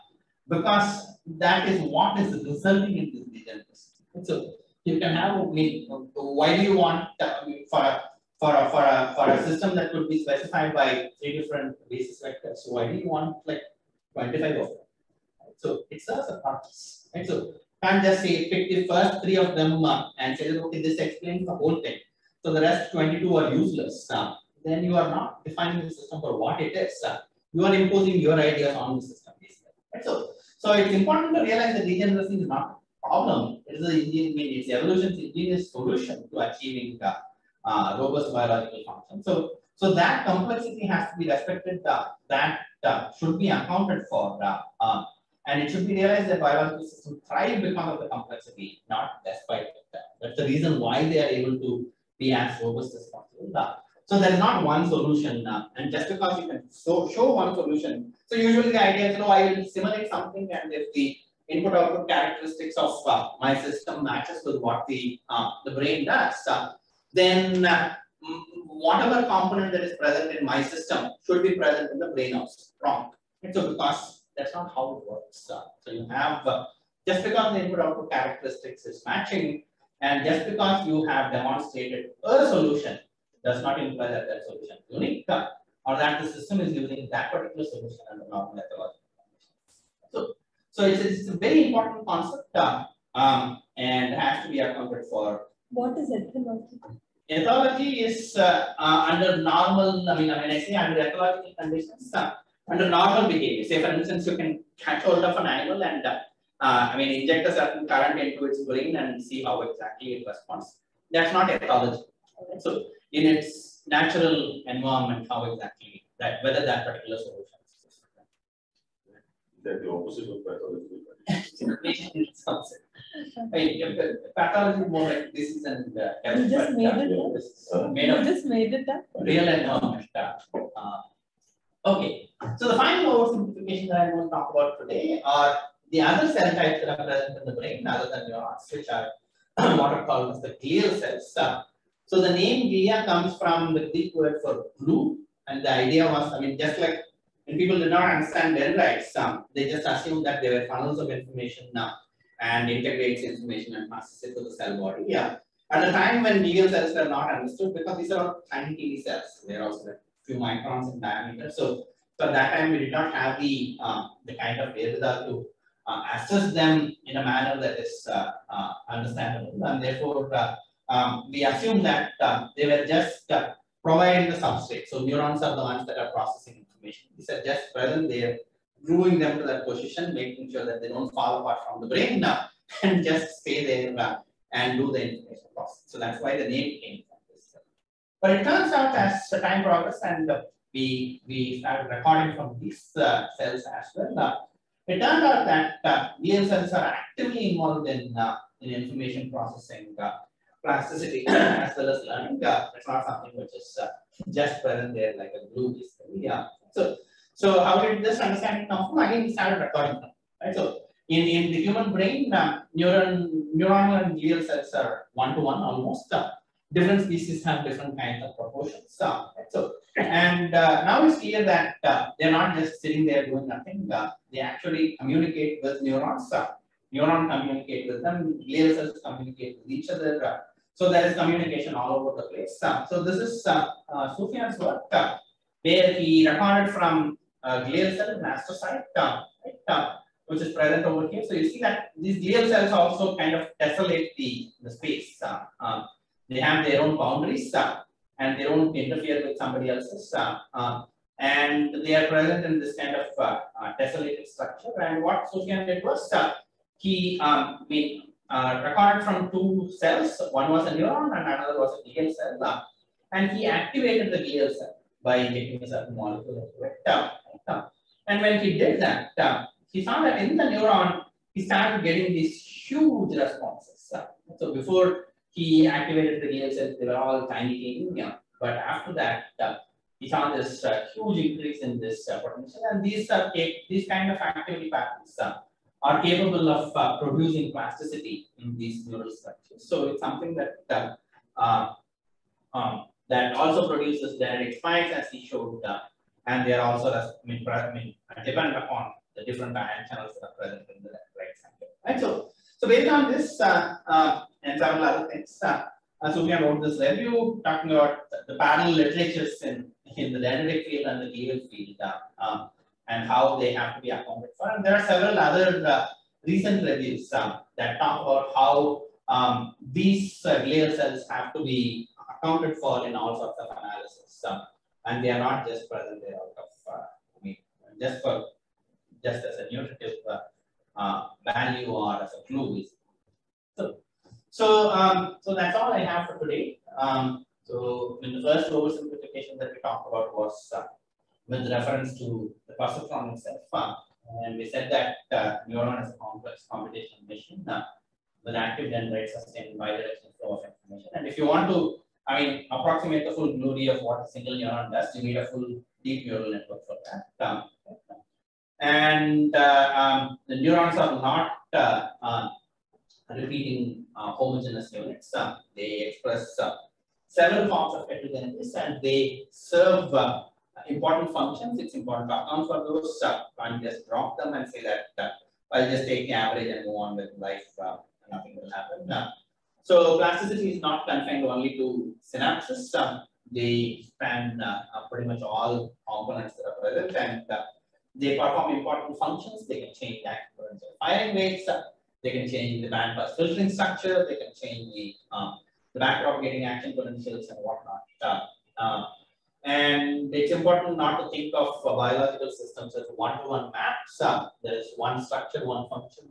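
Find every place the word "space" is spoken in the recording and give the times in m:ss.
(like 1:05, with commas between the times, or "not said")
4:04.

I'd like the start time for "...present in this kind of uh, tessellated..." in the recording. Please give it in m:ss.
4:12.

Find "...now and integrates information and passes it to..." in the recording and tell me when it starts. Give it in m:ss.
2:31.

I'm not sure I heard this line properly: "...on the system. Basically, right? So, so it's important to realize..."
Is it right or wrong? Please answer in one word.
right.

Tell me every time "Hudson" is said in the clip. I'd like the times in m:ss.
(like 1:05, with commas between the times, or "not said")
not said.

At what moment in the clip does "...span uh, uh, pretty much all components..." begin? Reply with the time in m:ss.
6:23.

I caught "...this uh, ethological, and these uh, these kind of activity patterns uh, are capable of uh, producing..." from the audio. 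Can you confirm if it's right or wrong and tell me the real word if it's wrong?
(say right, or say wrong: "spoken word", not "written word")
wrong: "potential", not "ethological".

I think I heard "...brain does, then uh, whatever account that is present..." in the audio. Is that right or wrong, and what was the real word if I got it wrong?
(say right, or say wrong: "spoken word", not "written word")
wrong: "component", not "account".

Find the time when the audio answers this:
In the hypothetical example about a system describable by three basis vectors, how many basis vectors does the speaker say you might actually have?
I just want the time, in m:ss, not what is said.
0:14.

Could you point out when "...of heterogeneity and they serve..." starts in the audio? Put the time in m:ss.
6:07.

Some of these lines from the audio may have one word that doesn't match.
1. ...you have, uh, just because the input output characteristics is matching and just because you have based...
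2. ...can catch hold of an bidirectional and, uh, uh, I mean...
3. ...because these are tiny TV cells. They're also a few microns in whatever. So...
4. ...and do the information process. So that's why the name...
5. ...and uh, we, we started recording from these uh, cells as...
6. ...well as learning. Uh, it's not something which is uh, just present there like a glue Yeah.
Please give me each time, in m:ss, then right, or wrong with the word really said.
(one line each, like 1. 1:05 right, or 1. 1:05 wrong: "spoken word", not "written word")
1. 1:15 wrong: "demonstrated", not "based"
2. 1:44 wrong: "animal", not "bidirectional"
3. 2:37 wrong: "diameter", not "whatever"
4. 3:04 right
5. 3:10 right
6. 3:21 right.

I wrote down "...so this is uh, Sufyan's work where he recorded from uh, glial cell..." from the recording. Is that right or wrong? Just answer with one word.
right.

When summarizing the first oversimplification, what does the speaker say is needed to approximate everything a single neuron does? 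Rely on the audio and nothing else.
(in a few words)
A full deep neural network.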